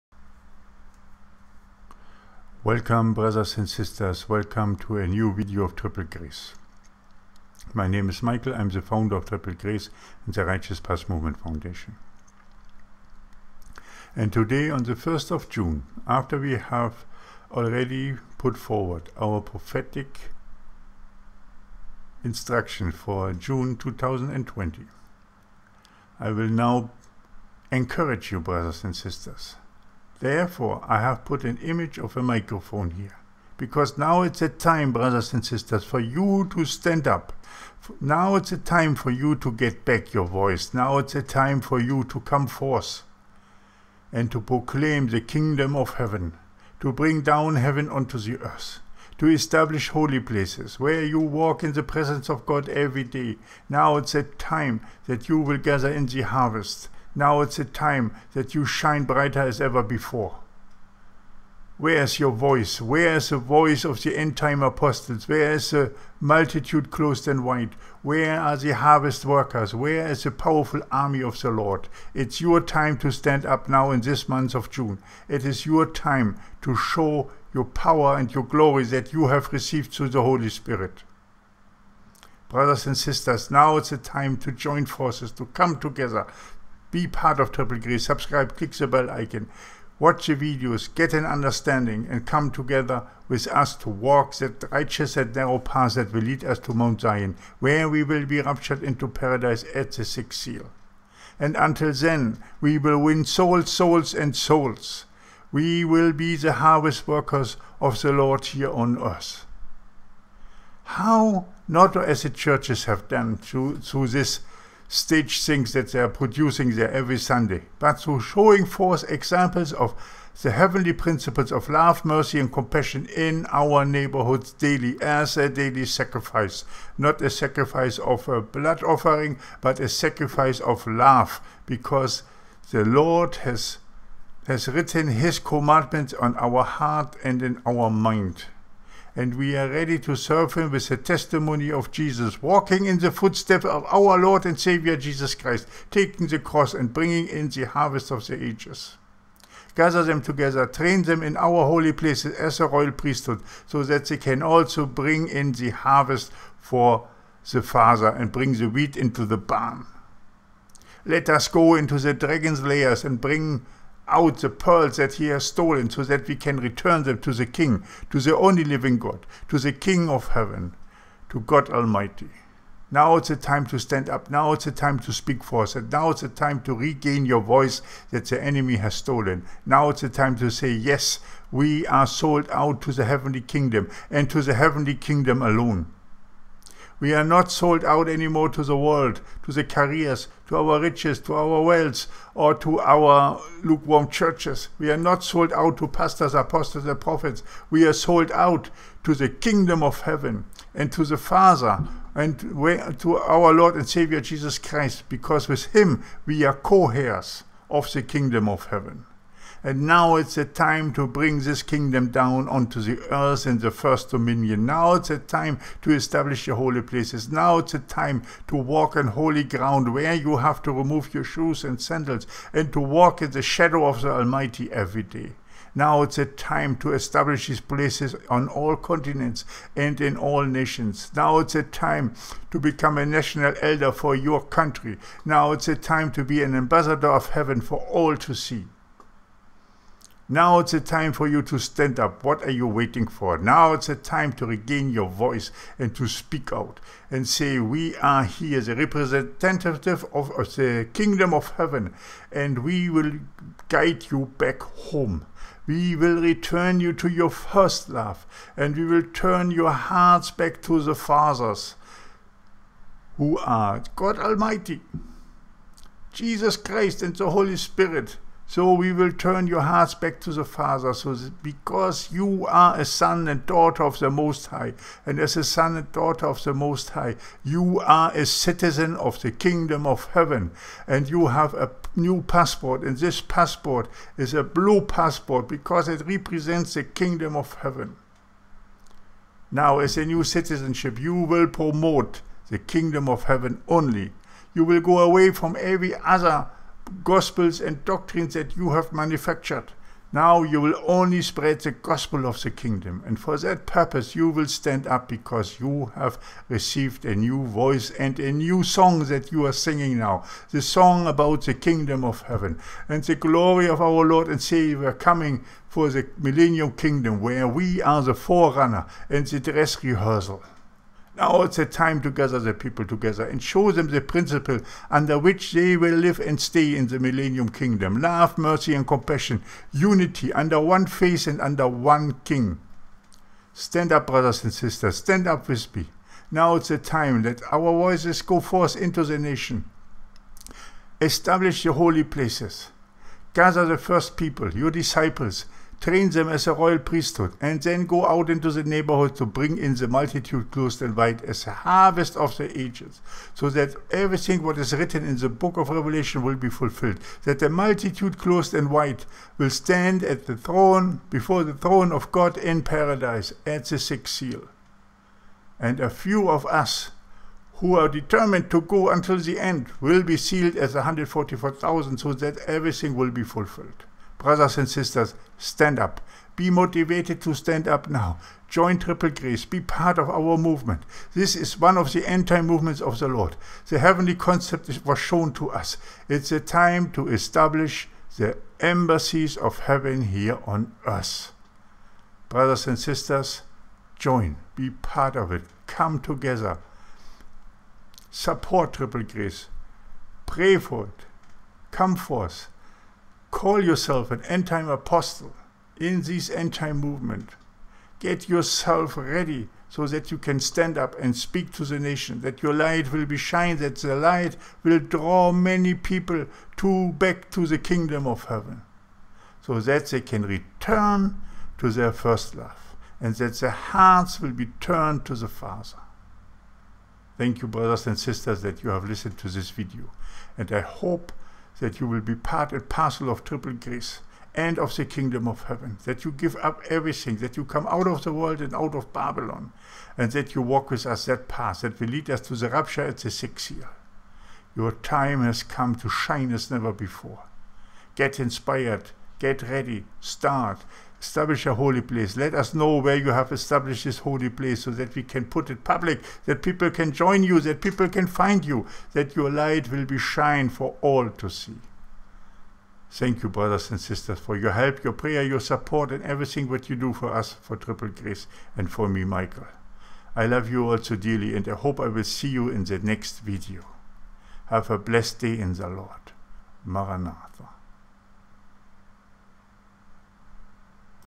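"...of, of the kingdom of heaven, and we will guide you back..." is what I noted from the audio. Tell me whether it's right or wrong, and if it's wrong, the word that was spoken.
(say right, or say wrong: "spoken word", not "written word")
right.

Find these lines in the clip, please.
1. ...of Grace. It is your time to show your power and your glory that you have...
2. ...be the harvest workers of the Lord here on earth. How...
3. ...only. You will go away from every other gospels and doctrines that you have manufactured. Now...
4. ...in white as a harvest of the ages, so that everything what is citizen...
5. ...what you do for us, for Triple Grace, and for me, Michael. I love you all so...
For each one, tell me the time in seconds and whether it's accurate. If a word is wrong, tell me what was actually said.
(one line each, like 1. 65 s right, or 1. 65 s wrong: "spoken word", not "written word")
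1. 74 s wrong: "June", not "Grace"
2. 106 s right
3. 293 s right
4. 350 s wrong: "written", not "citizen"
5. 466 s right.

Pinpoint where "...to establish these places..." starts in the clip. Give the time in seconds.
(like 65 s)
226 s.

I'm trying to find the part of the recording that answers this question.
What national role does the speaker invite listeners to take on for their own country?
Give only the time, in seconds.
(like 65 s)
233 s.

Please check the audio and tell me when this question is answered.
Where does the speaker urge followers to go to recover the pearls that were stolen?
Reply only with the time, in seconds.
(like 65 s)
162 s.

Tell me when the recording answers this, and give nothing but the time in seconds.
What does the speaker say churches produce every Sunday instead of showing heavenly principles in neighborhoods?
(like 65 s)
114 s.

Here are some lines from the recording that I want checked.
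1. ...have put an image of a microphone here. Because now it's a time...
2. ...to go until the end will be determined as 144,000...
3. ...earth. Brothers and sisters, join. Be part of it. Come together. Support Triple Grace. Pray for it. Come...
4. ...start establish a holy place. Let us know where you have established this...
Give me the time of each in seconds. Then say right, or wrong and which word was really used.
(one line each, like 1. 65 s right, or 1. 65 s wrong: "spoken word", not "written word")
1. 31 s right
2. 368 s wrong: "sealed", not "determined"
3. 390 s right
4. 449 s right.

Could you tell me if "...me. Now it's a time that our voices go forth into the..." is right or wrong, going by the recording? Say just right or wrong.
right.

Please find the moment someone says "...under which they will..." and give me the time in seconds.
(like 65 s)
324 s.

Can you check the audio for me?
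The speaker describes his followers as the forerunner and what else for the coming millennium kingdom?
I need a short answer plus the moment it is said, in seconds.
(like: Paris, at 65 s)
The dress rehearsal, at 319 s.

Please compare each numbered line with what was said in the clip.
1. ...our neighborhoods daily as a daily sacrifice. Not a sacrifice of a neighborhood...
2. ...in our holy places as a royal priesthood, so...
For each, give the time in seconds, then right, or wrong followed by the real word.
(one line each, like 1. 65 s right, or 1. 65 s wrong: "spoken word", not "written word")
1. 123 s wrong: "blood", not "neighborhood"
2. 151 s right.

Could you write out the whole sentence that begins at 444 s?
Your time has come to shine as never before.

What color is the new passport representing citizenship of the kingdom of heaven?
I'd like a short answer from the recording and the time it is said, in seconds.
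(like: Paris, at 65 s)
Blue, at 284 s.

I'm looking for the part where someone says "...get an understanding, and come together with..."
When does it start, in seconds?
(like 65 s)
90 s.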